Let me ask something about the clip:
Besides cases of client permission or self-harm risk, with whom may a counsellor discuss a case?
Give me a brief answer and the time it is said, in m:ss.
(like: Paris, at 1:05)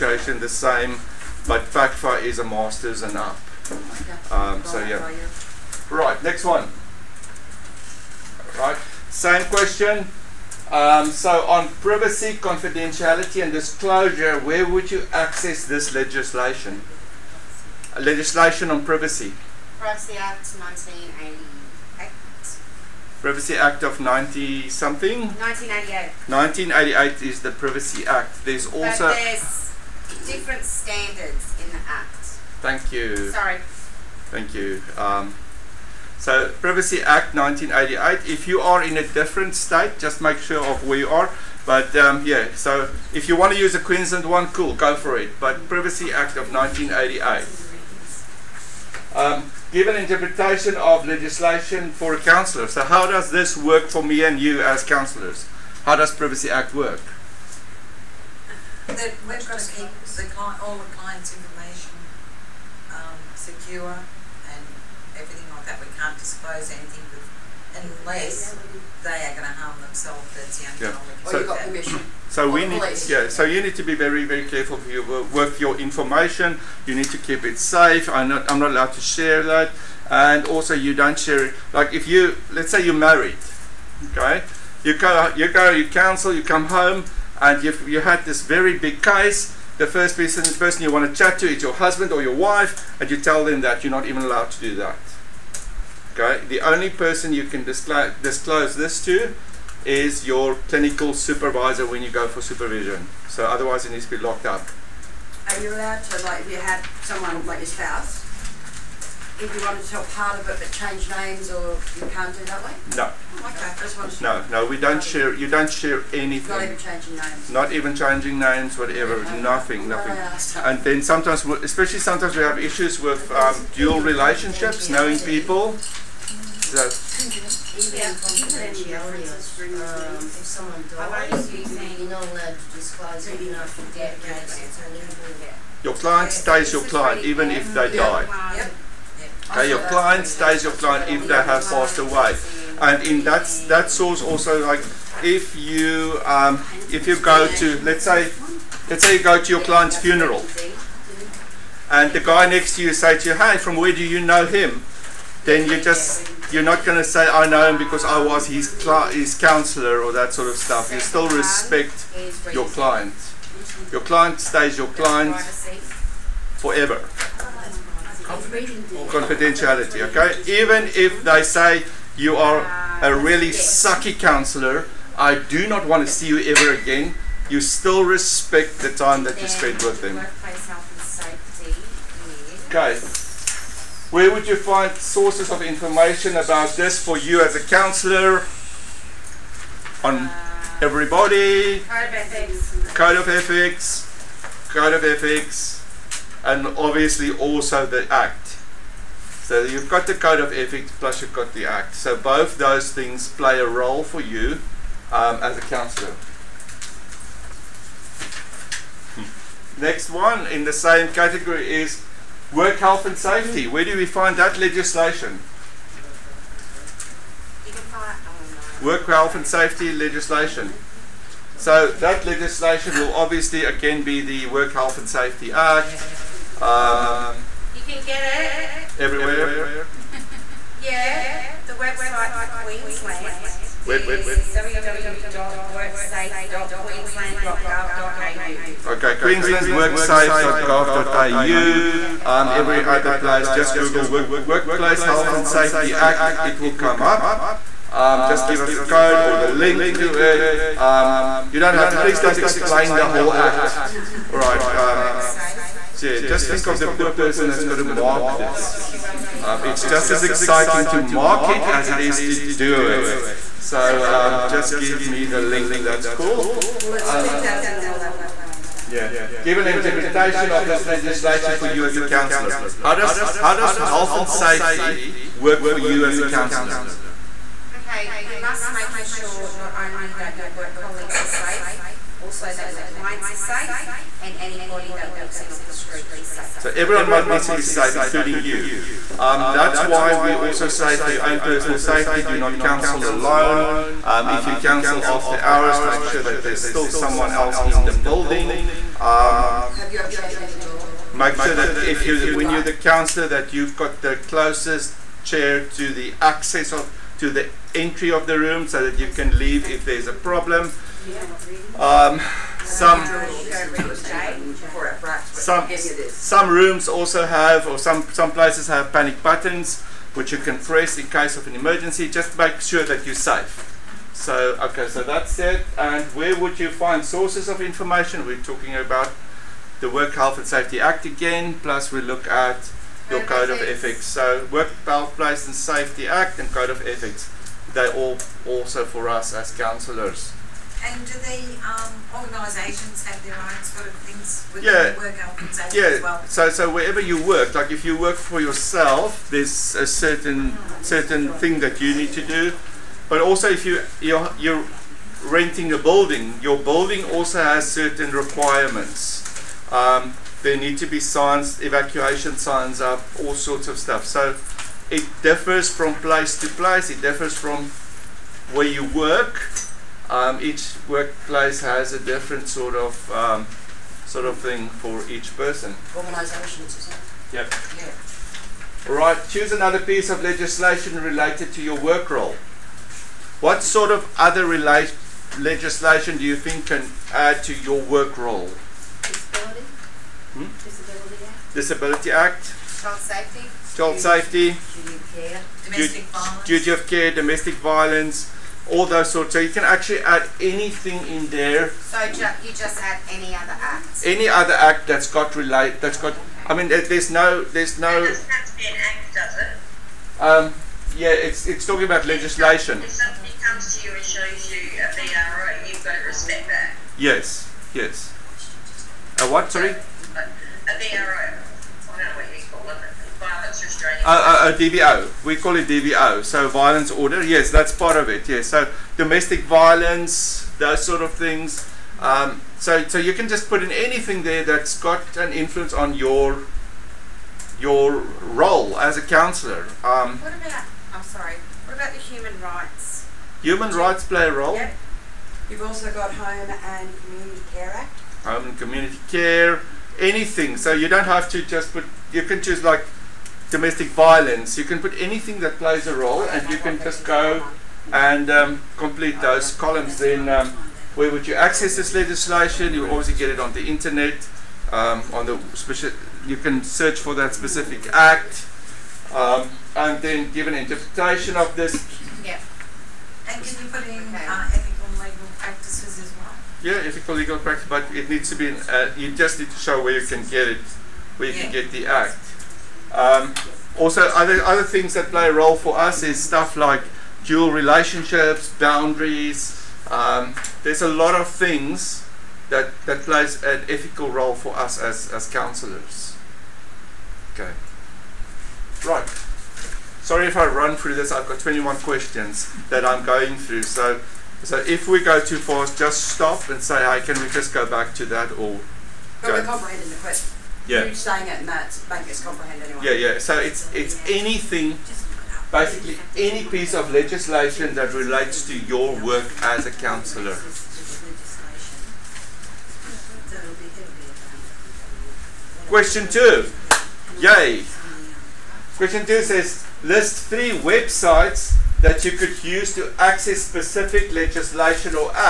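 clinical supervisor, at 1:40.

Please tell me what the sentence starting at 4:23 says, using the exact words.
So um, just give me the link, that's cool.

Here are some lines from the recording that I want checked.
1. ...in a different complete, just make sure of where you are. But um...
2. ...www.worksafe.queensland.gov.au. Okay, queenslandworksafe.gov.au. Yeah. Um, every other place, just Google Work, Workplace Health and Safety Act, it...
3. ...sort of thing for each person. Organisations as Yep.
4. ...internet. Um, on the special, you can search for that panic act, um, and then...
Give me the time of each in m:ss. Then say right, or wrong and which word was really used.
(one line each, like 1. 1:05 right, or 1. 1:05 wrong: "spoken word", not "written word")
1. 0:38 wrong: "state", not "complete"
2. 3:54 right
3. 6:14 right
4. 7:43 wrong: "specific", not "panic".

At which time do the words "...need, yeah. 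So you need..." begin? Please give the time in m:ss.
1:12.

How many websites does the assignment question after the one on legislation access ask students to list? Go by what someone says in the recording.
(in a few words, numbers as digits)
3.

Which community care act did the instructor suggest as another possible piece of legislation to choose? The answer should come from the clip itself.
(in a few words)
Home and Community Care Act.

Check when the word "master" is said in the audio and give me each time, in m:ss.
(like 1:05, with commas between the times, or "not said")
0:02.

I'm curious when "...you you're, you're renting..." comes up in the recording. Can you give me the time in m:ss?
5:53.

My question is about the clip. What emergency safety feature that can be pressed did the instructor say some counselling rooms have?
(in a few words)
panic buttons.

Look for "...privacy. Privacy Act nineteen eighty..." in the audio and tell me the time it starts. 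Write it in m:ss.
0:18.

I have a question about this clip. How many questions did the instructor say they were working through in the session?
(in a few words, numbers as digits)
21.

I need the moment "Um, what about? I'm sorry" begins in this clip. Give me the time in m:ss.
7:19.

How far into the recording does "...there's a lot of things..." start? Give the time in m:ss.
8:10.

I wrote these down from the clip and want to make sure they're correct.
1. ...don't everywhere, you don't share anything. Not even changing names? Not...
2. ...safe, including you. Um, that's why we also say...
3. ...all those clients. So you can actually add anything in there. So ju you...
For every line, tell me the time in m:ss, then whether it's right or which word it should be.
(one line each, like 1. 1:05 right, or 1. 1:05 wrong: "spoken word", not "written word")
1. 1:54 wrong: "share", not "everywhere"
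2. 4:47 right
3. 6:38 wrong: "sorts", not "clients".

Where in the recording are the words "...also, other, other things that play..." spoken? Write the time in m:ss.
8:03.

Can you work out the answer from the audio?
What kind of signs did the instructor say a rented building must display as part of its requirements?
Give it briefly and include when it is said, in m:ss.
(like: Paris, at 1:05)
evacuation signs, at 6:01.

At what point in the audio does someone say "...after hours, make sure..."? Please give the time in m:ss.
4:55.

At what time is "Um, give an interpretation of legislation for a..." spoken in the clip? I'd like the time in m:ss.
0:49.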